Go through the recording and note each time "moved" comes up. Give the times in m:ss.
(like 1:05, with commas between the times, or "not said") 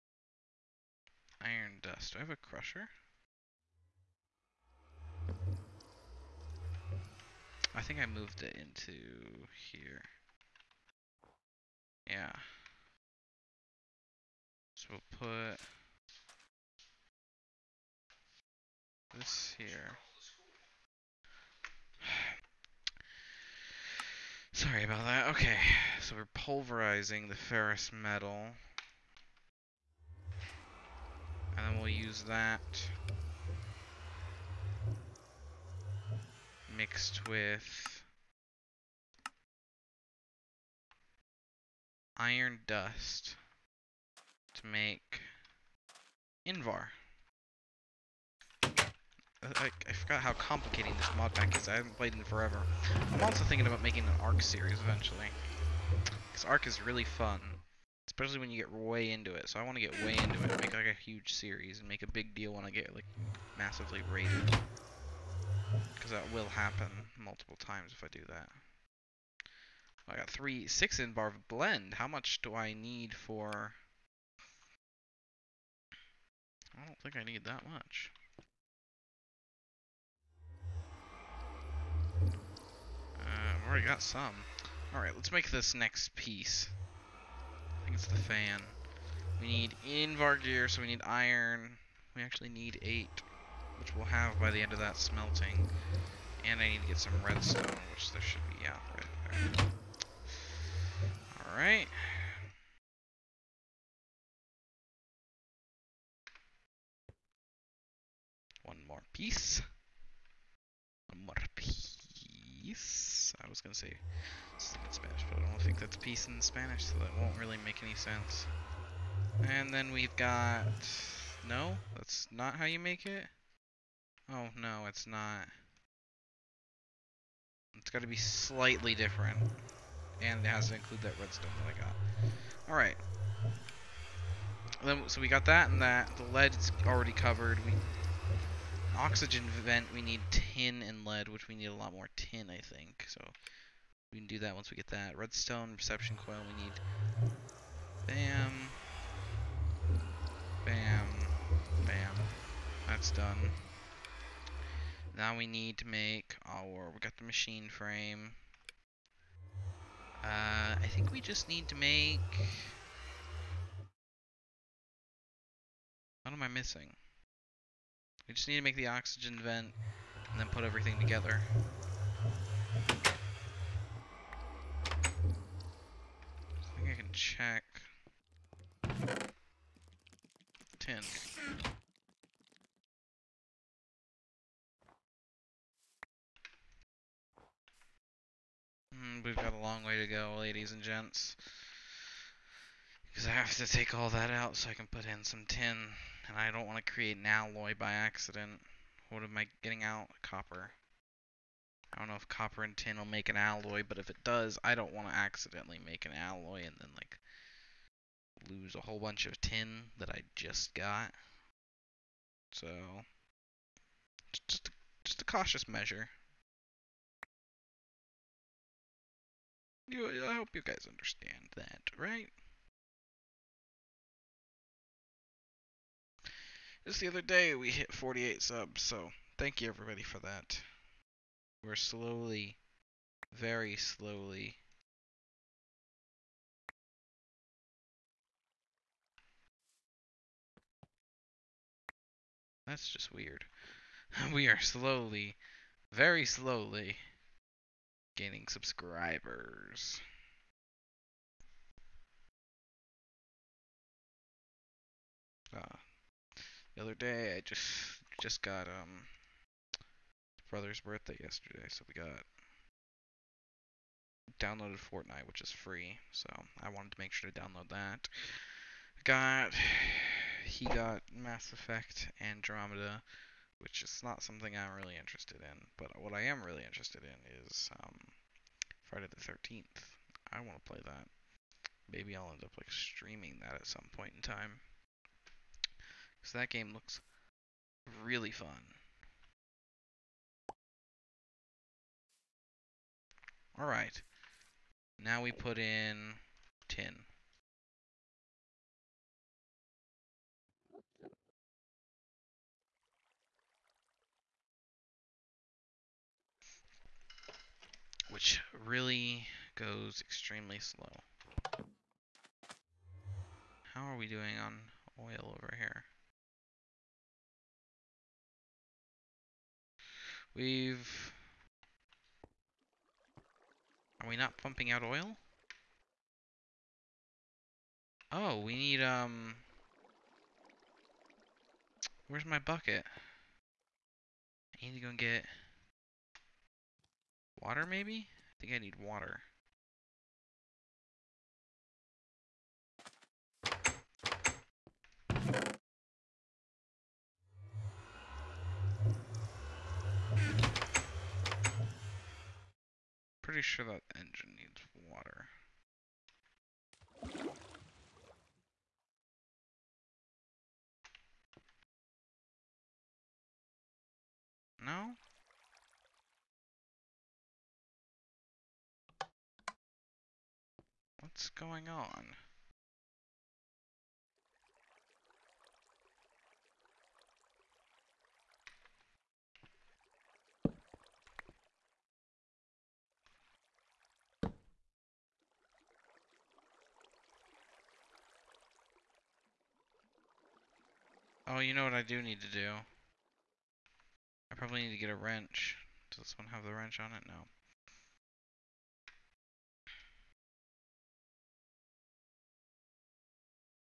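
0:08.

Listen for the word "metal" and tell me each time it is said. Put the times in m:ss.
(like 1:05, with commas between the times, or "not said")
0:27.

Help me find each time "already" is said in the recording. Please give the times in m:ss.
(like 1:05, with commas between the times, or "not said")
1:23, 2:16.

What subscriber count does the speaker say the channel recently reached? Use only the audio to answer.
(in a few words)
48.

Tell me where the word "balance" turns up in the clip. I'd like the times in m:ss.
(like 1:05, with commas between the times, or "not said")
not said.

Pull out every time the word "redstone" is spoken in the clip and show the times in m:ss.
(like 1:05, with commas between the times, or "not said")
1:37, 2:11, 2:25.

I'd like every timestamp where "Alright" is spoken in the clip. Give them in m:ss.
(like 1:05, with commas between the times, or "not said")
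1:24, 1:41, 2:12.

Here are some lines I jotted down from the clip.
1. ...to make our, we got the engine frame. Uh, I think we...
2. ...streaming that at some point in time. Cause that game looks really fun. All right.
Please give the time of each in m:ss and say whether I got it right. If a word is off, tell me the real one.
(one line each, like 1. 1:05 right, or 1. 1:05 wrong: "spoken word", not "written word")
1. 2:35 wrong: "machine", not "engine"
2. 4:42 right.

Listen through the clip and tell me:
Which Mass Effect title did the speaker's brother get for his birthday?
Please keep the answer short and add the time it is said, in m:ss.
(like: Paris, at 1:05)
Mass Effect Andromeda, at 4:31.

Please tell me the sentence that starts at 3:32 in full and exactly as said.
So, just, just a, just a cautious measure.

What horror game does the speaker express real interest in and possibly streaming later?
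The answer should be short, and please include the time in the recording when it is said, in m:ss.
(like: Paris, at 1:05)
Friday the 13th, at 4:38.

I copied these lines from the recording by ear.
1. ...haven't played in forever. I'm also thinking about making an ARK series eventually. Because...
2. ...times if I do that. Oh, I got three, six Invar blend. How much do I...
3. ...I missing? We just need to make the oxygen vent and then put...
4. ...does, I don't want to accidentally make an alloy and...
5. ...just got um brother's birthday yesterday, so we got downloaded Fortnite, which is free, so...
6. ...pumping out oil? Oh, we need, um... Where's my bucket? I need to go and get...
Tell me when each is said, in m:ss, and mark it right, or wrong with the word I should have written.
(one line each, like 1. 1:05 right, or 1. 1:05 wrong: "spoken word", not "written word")
1. 0:51 right
2. 1:07 right
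3. 2:46 right
4. 3:24 right
5. 4:18 right
6. 5:24 right.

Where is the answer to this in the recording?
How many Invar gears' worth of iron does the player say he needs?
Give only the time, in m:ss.
1:32.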